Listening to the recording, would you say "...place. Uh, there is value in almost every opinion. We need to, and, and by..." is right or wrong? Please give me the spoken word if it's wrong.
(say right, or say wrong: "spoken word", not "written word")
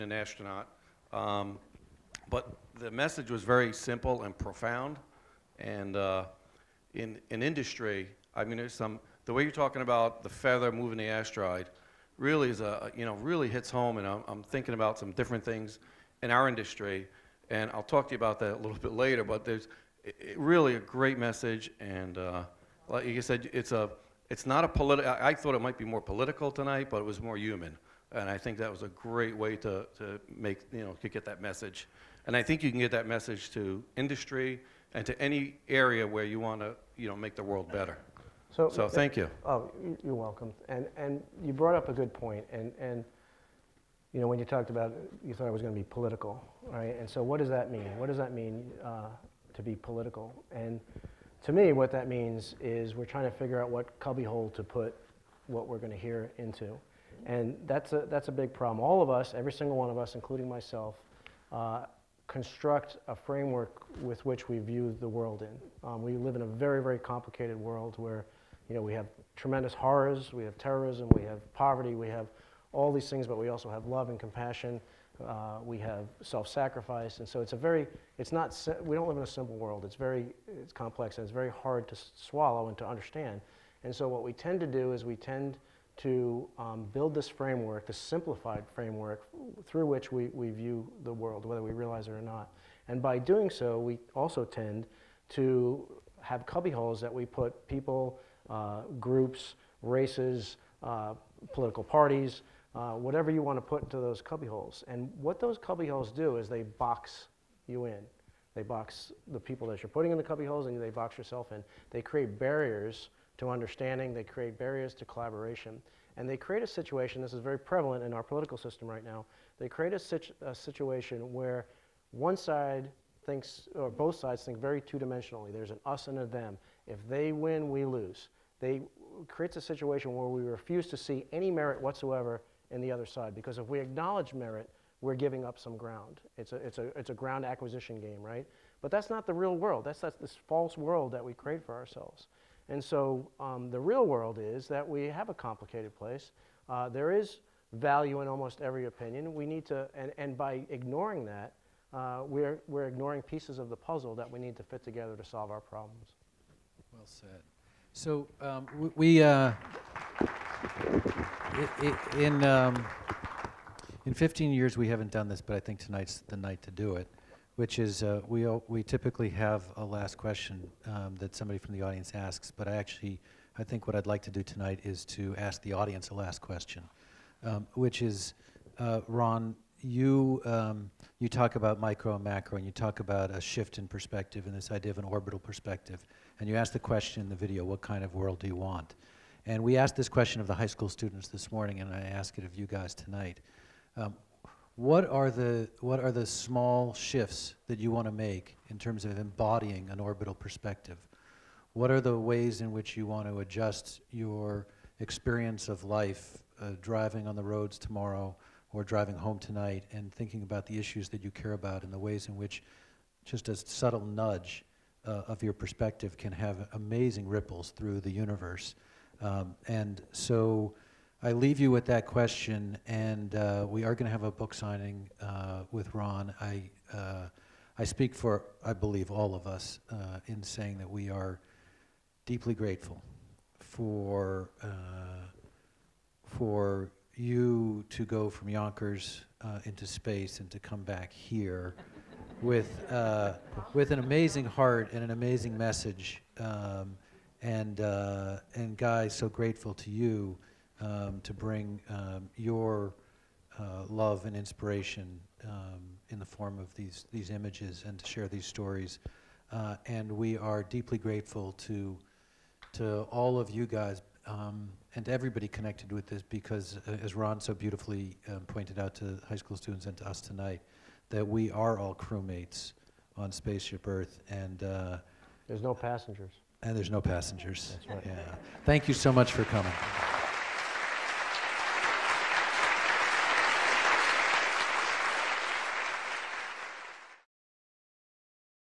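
right.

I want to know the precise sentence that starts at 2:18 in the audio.
But that's not the real world.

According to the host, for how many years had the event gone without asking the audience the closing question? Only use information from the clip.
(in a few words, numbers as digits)
15.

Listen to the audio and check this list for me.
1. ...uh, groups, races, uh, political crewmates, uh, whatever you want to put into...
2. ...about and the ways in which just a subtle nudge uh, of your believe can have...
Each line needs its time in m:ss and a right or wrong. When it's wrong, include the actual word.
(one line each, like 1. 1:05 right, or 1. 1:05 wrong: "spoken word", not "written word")
1. 1:38 wrong: "parties", not "crewmates"
2. 3:31 wrong: "perspective", not "believe".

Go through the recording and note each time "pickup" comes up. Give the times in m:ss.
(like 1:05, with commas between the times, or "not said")
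not said.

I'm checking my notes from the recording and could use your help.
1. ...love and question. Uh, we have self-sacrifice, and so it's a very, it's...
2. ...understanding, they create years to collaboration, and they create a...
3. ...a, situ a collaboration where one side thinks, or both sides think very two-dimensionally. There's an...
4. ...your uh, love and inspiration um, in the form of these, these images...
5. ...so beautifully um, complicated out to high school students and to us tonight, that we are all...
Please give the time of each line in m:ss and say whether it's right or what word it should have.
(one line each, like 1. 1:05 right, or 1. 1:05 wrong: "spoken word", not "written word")
1. 1:13 wrong: "compassion", not "question"
2. 1:53 wrong: "barriers", not "years"
3. 1:59 wrong: "situation", not "collaboration"
4. 4:12 right
5. 4:27 wrong: "pointed", not "complicated".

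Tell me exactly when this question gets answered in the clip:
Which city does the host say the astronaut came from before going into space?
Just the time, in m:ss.
3:58.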